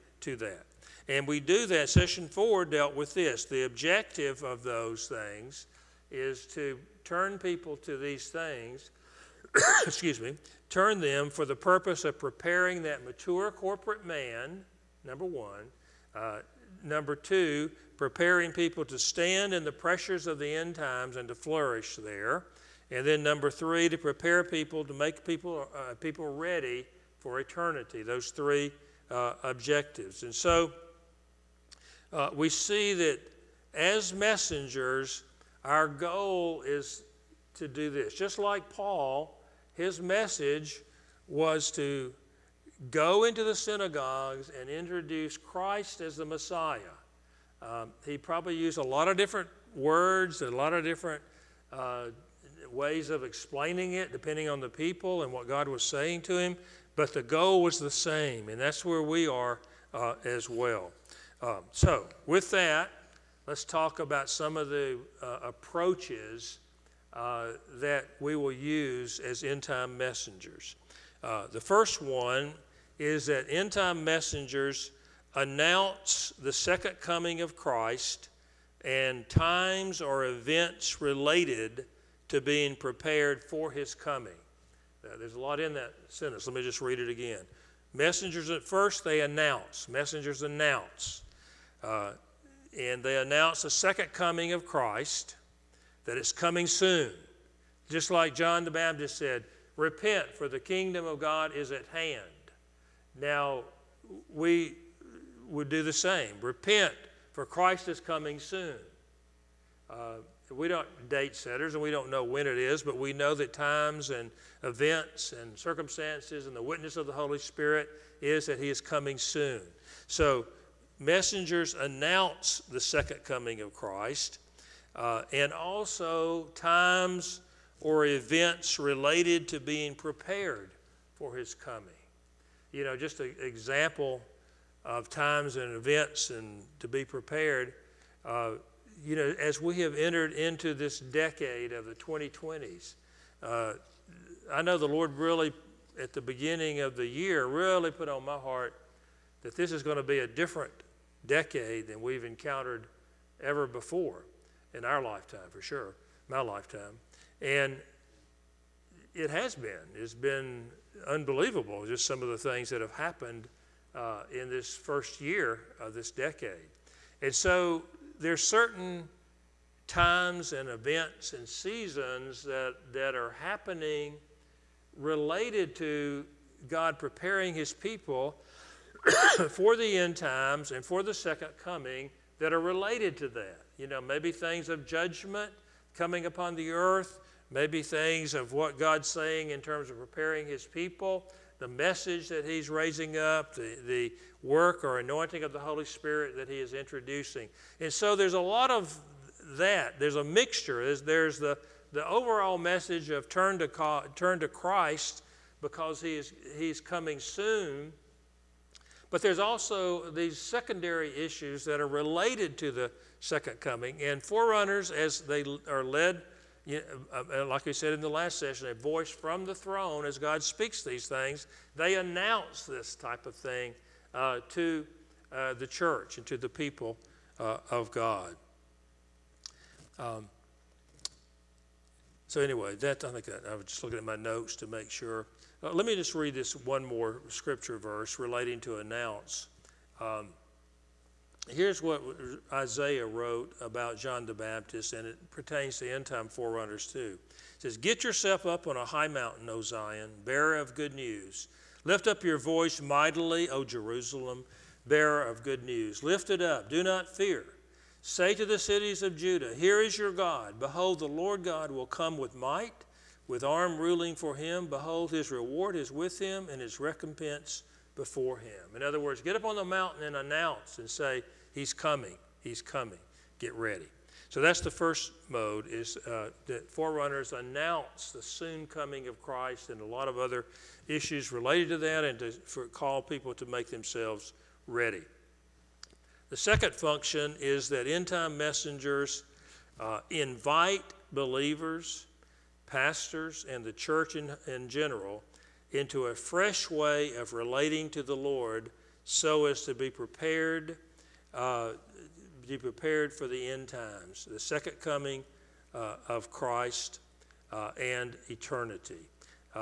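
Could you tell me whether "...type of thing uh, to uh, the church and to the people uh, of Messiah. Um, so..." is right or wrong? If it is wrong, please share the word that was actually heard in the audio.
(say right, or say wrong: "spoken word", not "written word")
wrong: "God", not "Messiah".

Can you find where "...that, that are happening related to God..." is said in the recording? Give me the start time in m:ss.
2:52.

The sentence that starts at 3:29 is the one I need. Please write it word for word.
But there's also these secondary issues that are related to the second coming.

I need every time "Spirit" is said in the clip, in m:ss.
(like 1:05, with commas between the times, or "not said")
1:57, 3:15.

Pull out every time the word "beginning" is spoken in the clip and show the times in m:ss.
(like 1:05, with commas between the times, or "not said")
2:26.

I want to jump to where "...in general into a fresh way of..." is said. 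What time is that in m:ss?
4:54.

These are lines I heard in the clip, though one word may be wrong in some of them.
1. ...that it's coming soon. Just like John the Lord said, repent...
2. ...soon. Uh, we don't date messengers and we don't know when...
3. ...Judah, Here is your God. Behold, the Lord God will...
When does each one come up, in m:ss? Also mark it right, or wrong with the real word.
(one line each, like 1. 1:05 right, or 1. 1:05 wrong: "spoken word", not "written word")
1. 1:36 wrong: "Baptist", not "Lord"
2. 1:48 wrong: "setters", not "messengers"
3. 4:19 right.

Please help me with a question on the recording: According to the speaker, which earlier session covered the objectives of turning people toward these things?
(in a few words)
Session 4.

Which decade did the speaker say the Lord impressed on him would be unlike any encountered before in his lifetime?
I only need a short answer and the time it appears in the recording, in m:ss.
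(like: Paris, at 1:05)
the 2020s, at 2:21.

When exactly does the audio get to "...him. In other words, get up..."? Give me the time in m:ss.
4:28.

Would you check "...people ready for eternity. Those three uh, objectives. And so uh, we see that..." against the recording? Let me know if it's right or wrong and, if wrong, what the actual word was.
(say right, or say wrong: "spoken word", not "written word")
right.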